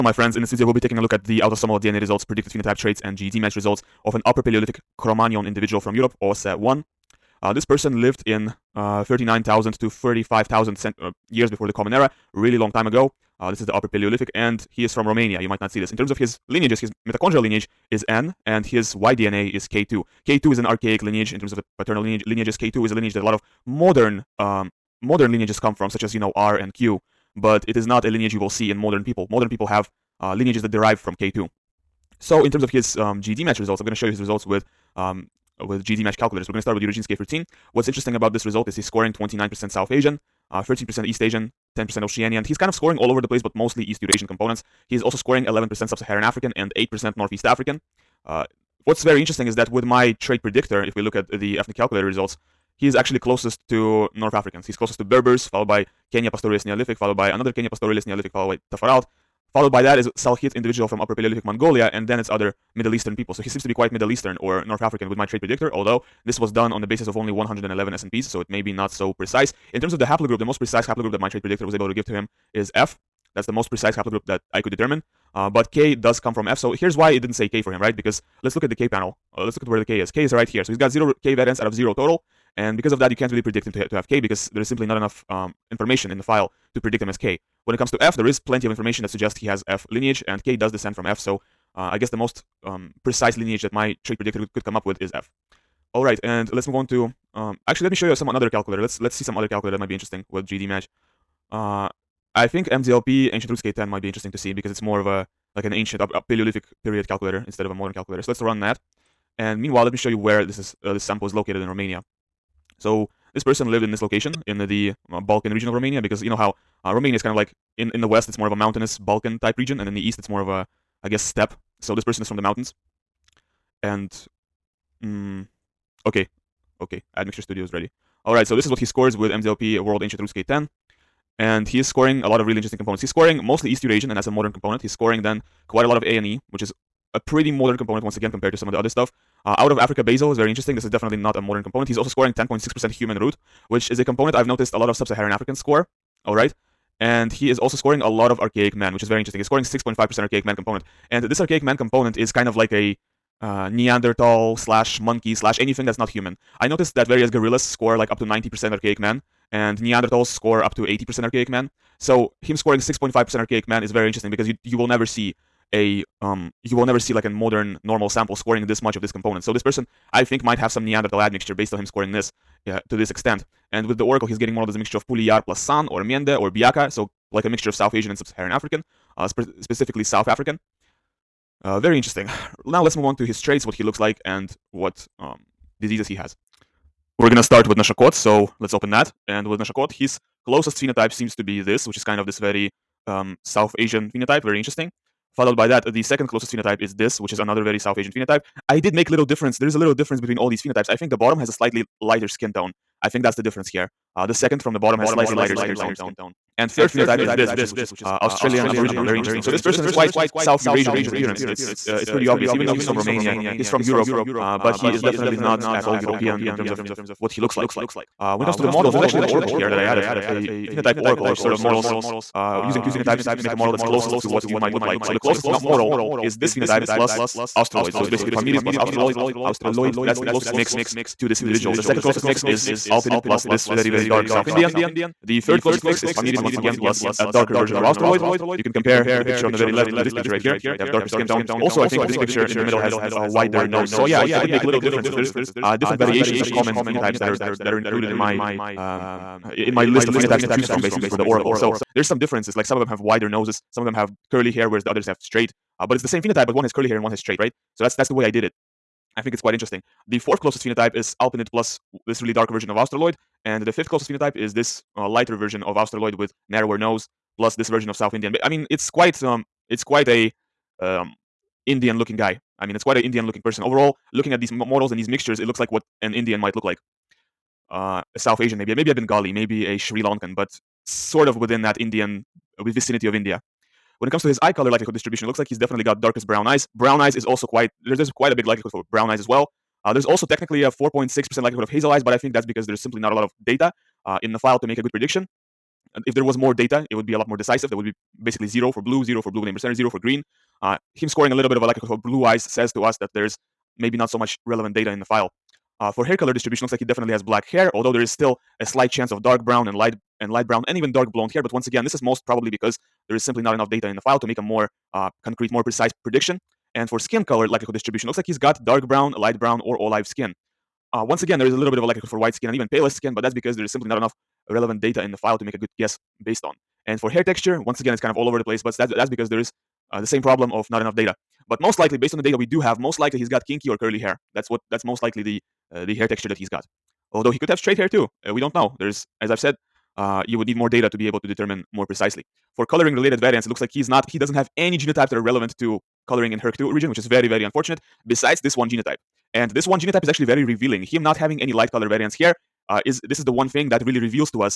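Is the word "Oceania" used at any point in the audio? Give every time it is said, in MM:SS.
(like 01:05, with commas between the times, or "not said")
00:42.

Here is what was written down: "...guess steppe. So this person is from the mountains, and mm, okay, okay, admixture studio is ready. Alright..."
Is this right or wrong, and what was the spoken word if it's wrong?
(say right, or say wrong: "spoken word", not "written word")
right.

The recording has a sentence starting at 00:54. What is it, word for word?
He's closest to Berbers, followed by Kenya Pastoralist Neolithic, followed by another Kenya Pastoralist Neolithic, followed by Taforalt.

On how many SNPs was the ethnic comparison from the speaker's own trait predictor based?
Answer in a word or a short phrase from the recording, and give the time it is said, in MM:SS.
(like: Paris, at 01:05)
111, at 01:07.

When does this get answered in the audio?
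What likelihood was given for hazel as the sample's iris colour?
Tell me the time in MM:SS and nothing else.
04:50.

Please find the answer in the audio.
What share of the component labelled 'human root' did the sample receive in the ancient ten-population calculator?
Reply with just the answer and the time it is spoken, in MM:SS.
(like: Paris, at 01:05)
10.6%, at 02:22.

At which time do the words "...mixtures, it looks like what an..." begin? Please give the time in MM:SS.
04:35.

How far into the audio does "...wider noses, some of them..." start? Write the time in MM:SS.
04:12.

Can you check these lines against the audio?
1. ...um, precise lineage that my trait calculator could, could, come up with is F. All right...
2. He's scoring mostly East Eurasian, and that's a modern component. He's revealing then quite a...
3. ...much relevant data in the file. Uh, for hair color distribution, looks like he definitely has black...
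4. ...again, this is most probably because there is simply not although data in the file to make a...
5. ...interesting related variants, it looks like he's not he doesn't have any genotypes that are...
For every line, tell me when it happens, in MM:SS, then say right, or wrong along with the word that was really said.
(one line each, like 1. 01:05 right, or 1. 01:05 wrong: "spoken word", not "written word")
1. 01:32 wrong: "predictor", not "calculator"
2. 02:13 wrong: "scoring", not "revealing"
3. 05:04 right
4. 05:11 wrong: "enough", not "although"
5. 05:42 wrong: "coloring", not "interesting".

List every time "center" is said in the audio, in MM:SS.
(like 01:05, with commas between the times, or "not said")
04:59.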